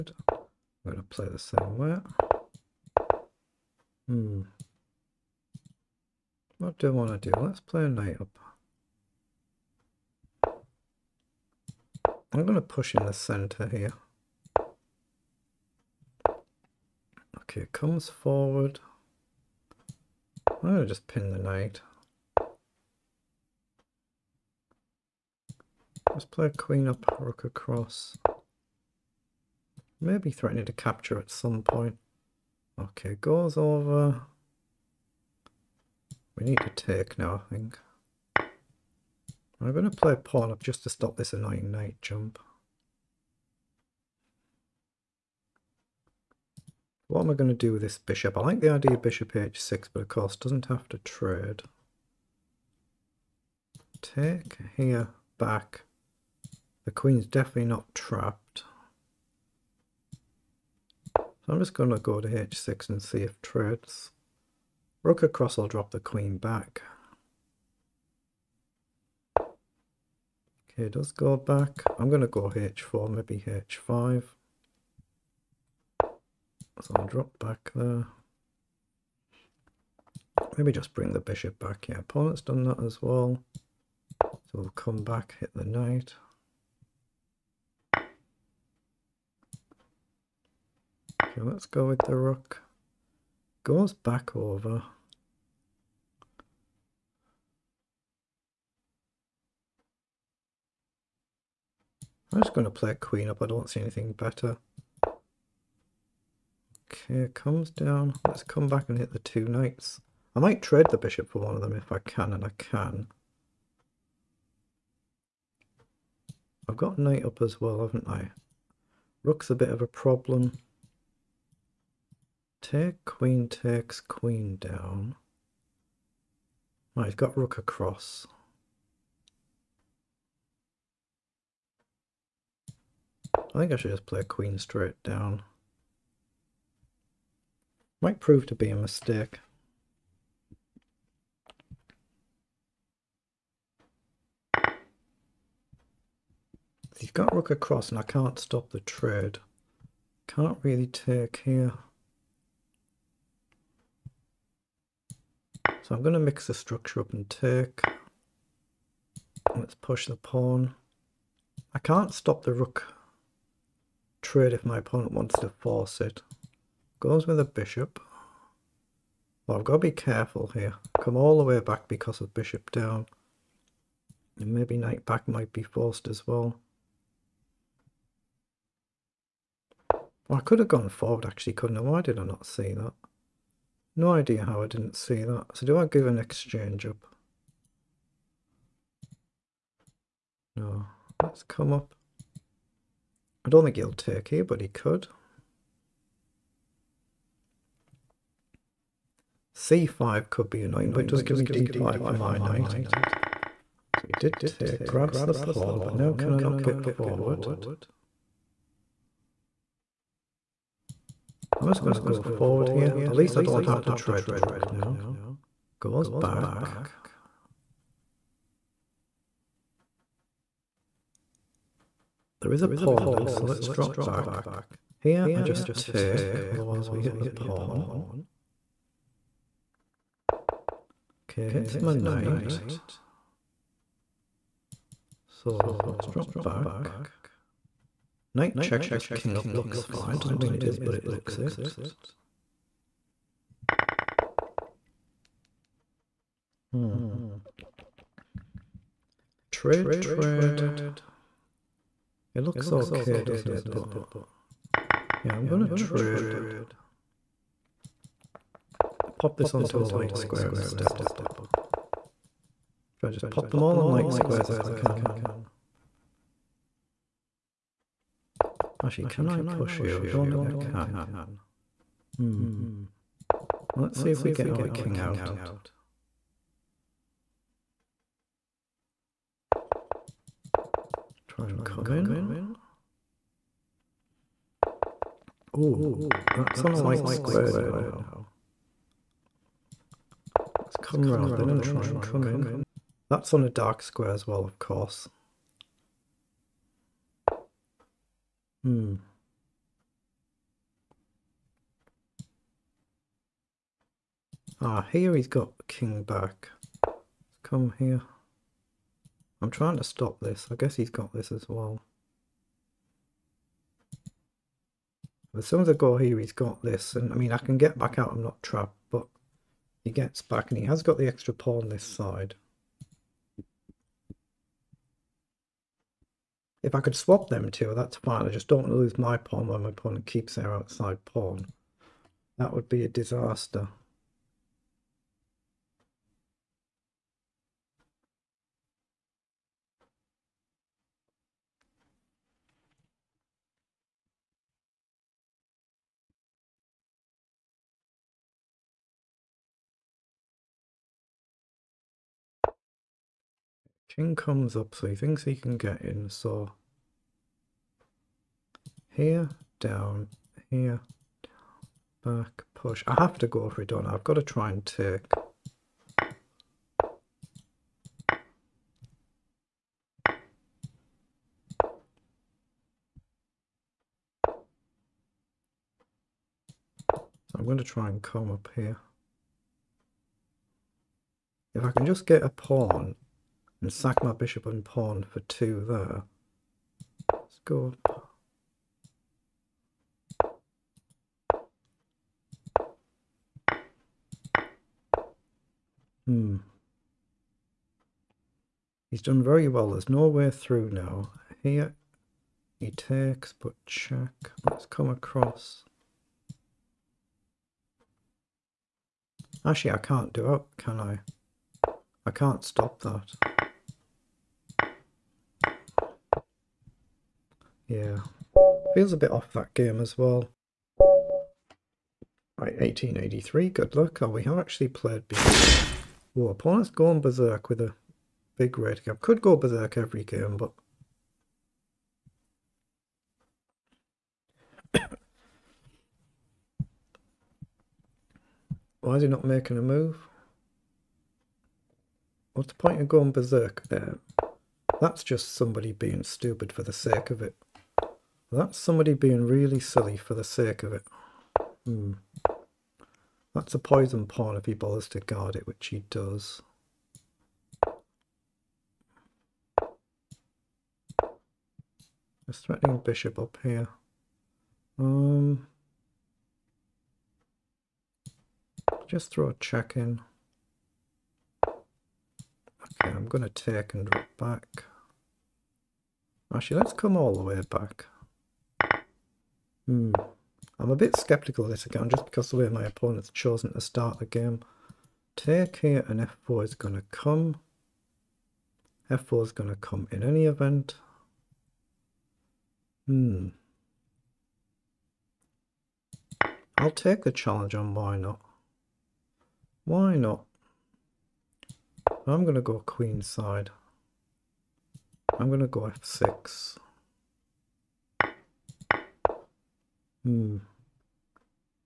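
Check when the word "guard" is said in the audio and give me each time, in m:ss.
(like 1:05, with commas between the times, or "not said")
7:34.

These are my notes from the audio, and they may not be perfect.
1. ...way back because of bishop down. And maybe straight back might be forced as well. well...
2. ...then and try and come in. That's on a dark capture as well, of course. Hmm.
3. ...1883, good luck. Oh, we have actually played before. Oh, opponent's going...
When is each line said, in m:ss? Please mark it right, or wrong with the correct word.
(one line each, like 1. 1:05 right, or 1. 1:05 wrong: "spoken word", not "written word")
1. 2:51 wrong: "knight", not "straight"
2. 4:51 wrong: "square", not "capture"
3. 7:02 right.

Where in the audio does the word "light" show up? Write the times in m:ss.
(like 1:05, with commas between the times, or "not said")
4:19, 4:23, 4:46.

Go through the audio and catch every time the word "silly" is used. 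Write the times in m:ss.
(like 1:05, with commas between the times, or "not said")
7:29.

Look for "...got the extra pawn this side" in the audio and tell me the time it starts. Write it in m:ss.
5:20.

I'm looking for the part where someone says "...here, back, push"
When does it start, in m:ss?
6:00.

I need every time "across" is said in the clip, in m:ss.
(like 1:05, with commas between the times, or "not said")
0:27, 1:05, 2:07, 2:27, 6:44.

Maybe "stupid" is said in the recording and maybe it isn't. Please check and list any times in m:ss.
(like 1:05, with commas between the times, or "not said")
7:26.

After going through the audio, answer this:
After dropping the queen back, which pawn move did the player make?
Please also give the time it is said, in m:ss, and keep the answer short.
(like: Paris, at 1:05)
h4, at 1:12.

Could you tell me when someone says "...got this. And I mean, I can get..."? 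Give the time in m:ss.
5:16.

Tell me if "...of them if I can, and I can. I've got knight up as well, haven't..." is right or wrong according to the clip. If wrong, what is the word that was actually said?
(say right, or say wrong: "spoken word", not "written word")
right.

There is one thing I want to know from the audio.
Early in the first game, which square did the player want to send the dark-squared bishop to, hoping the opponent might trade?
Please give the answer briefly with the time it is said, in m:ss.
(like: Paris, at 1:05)
h6, at 0:49.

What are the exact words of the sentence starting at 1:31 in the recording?
Okay, let's go with the rook goes back over.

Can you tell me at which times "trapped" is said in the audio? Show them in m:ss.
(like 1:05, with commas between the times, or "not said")
0:57, 5:18.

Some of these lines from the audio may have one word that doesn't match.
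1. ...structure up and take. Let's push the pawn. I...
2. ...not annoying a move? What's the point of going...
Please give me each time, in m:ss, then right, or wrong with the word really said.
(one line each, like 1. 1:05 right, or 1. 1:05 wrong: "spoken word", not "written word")
1. 2:36 right
2. 7:19 wrong: "making", not "annoying".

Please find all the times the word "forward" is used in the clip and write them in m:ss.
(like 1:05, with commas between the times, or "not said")
0:18, 3:00, 3:26, 3:32.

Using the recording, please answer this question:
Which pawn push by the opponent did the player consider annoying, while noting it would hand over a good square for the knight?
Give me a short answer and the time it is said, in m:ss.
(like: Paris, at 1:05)
c5, at 3:19.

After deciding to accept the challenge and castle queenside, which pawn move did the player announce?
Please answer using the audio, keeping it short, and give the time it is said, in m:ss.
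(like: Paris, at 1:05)
f6, at 8:25.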